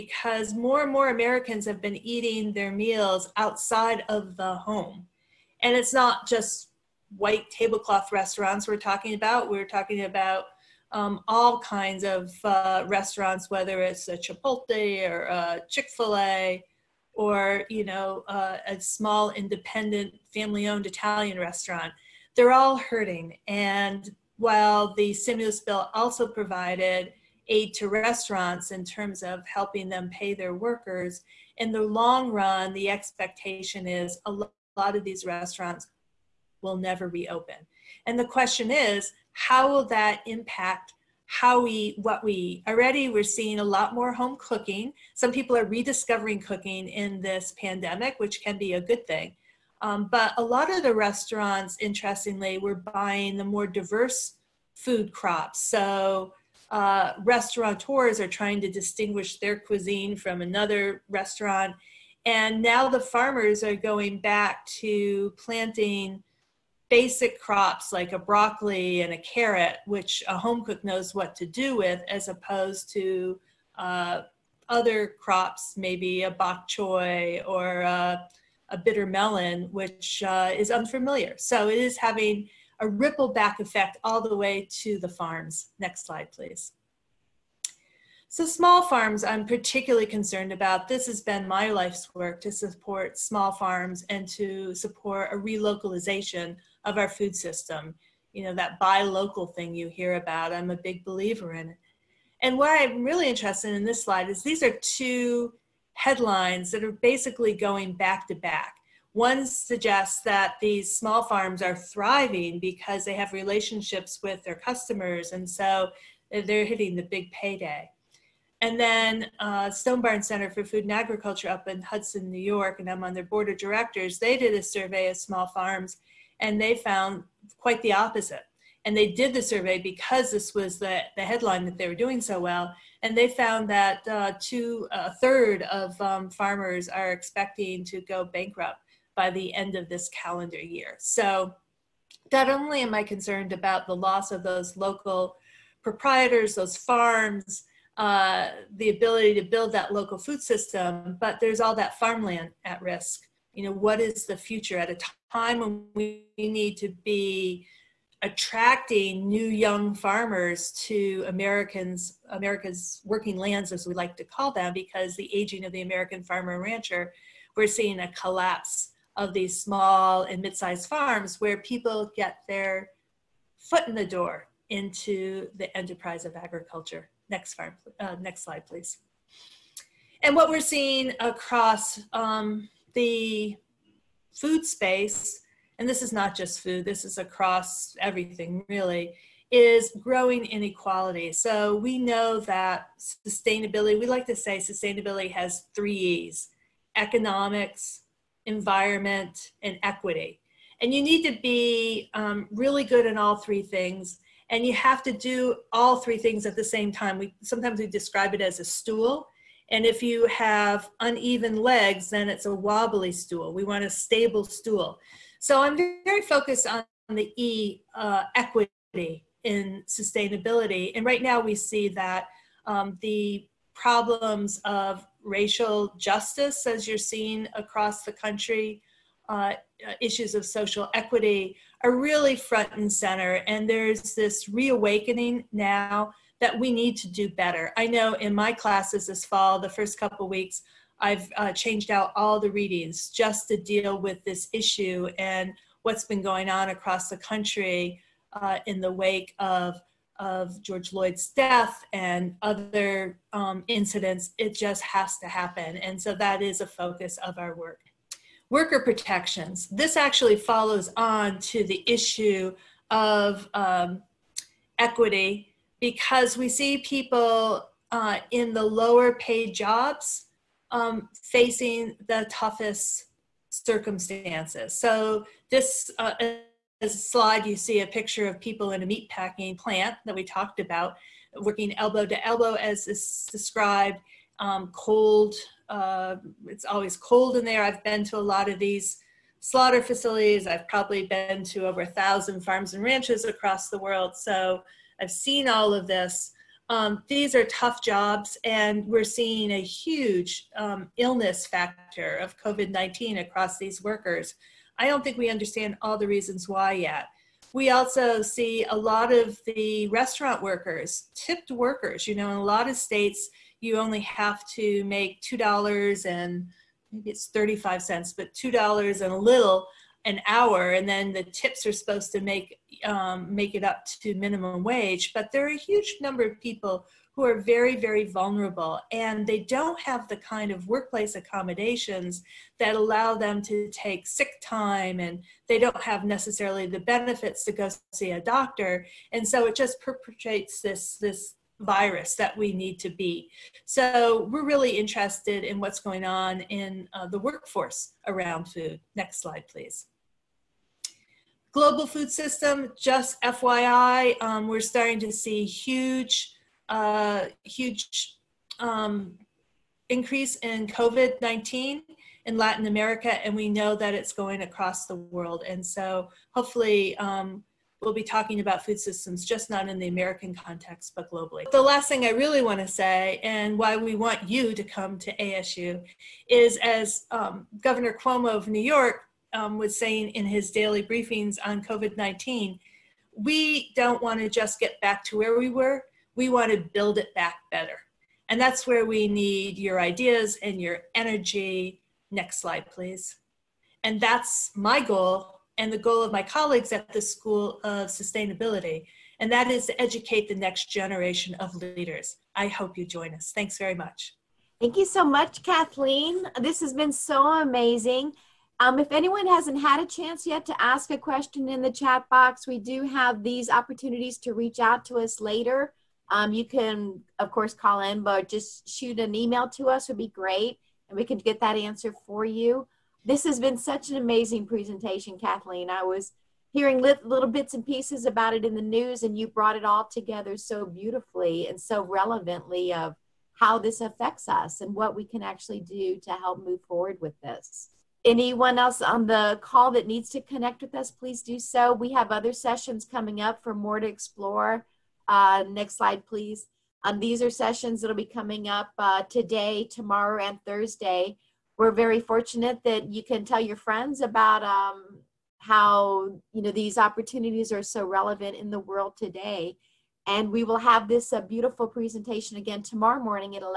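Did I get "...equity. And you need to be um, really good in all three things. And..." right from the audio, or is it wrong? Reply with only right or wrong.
right.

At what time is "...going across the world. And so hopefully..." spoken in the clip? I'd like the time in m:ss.
6:04.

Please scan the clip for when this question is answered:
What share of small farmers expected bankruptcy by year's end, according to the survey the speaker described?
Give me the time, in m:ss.
2:14.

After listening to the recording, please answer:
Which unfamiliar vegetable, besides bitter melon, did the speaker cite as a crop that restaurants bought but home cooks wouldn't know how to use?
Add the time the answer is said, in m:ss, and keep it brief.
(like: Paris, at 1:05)
bok choy, at 1:16.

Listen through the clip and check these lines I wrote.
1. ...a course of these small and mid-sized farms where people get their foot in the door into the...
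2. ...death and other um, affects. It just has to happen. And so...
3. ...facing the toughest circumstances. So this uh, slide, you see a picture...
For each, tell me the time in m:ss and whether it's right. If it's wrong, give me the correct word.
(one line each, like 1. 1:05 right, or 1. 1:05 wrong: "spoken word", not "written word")
1. 2:47 wrong: "collapse", not "course"
2. 4:11 wrong: "incidents", not "affects"
3. 4:31 right.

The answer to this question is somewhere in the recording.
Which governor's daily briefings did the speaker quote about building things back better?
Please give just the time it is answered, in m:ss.
6:17.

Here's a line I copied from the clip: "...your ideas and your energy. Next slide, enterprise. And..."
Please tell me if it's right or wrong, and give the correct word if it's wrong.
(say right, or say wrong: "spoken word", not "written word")
wrong: "please", not "enterprise".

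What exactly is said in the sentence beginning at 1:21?
So it is having a ripple back effect all the way to the farms.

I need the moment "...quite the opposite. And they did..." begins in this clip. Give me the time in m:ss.
2:07.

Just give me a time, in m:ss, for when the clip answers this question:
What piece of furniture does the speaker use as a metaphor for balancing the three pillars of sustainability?
3:28.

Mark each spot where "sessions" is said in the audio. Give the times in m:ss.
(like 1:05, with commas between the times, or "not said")
7:22, 7:27.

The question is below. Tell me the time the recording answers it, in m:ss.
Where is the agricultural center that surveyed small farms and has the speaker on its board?
2:01.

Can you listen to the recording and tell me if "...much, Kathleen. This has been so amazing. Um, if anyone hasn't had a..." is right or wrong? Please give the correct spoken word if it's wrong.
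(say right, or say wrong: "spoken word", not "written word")
right.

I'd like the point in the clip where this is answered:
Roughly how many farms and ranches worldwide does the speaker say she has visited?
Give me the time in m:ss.
4:51.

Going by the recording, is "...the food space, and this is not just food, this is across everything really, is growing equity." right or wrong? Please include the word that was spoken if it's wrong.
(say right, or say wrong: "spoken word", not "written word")
wrong: "inequality", not "equity".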